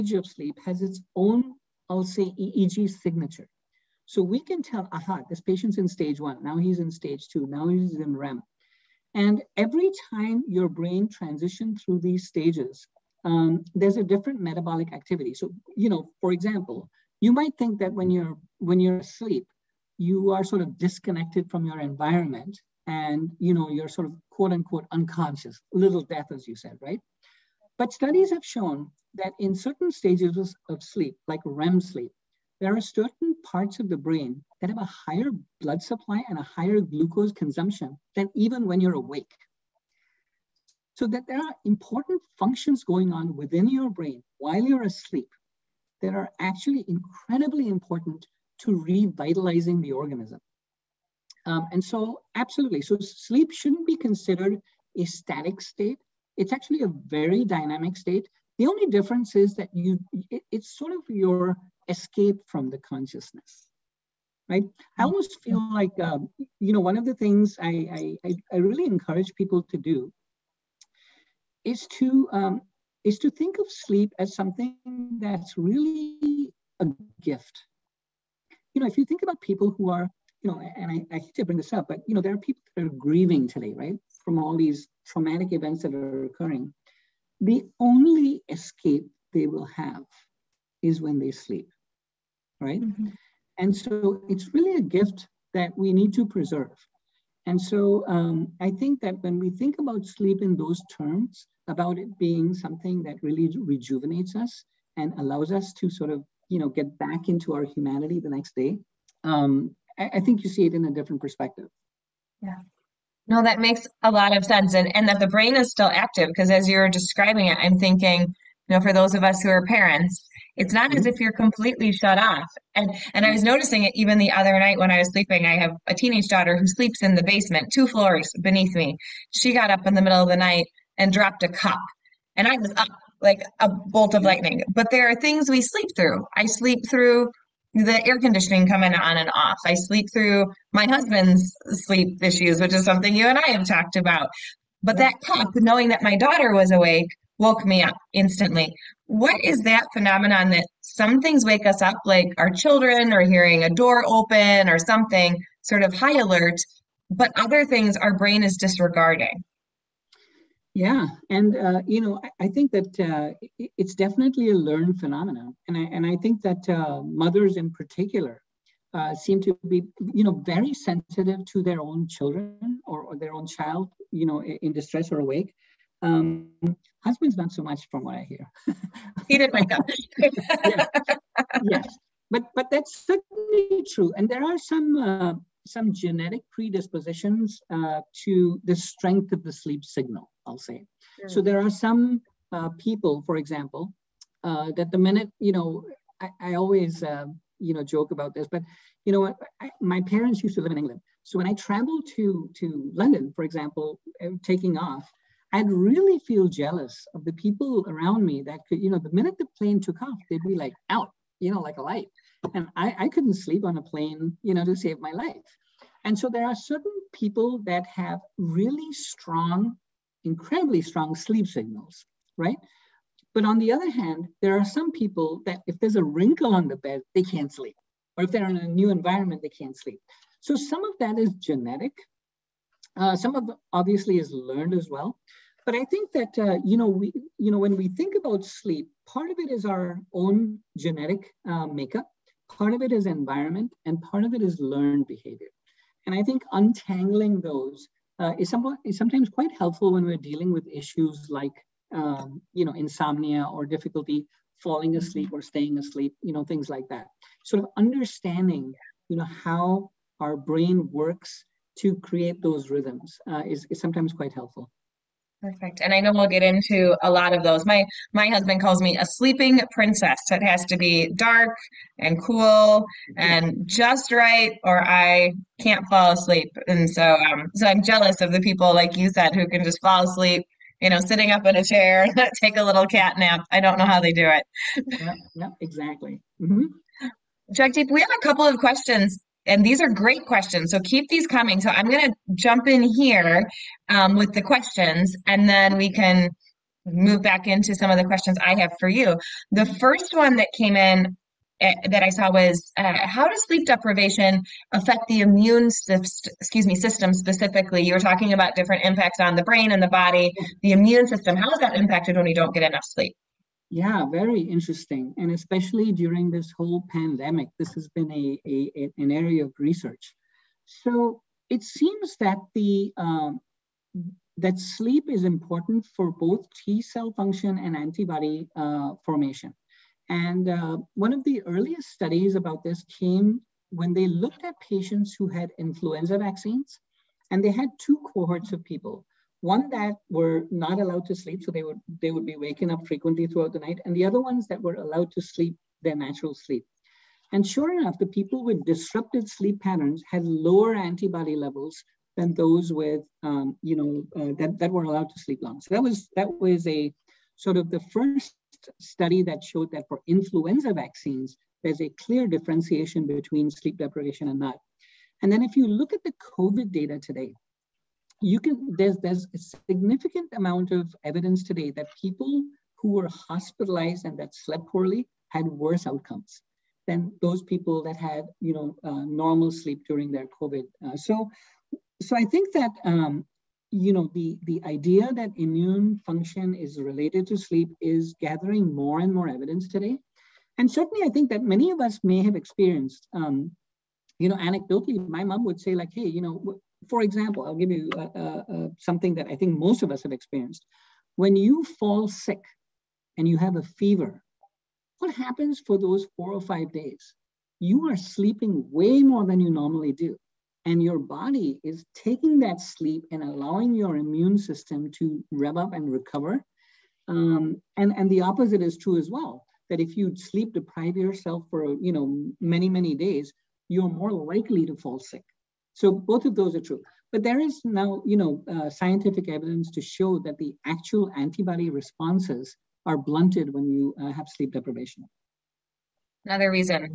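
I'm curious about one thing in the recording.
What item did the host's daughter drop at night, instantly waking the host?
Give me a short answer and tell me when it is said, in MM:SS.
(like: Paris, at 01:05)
A cup, at 02:11.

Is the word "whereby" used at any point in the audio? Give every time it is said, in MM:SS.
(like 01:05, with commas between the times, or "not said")
not said.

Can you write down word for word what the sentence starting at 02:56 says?
Um, husbands, not so much, from what I hear.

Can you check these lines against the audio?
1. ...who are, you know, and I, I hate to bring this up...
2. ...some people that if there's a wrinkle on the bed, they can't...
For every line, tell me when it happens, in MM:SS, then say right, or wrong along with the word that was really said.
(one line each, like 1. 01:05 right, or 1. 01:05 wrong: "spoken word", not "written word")
1. 01:19 right
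2. 03:44 right.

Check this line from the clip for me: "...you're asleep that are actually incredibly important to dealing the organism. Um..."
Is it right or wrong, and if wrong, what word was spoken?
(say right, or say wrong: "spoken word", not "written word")
wrong: "revitalizing", not "dealing".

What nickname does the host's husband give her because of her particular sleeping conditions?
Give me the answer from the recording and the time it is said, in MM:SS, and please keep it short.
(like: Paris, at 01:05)
Sleeping princess, at 04:29.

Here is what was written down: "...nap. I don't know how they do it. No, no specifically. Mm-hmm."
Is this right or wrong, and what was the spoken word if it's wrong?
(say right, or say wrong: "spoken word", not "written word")
wrong: "exactly", not "specifically".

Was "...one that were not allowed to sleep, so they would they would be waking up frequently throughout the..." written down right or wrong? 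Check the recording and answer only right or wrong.
right.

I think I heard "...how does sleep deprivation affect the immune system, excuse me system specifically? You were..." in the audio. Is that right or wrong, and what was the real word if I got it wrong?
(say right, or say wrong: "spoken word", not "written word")
right.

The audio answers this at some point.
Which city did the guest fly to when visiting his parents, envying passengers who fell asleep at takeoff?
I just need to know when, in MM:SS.
03:22.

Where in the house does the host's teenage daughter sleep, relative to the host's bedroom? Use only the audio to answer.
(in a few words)
The basement.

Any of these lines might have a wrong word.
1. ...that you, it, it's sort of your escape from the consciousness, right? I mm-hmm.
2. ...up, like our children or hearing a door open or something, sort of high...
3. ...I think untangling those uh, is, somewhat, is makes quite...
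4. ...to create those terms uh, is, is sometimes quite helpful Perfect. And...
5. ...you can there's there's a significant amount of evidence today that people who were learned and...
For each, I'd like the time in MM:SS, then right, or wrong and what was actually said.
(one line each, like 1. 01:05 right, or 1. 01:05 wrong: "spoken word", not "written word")
1. 00:59 right
2. 02:31 right
3. 04:06 wrong: "sometimes", not "makes"
4. 04:21 wrong: "rhythms", not "terms"
5. 06:08 wrong: "hospitalized", not "learned".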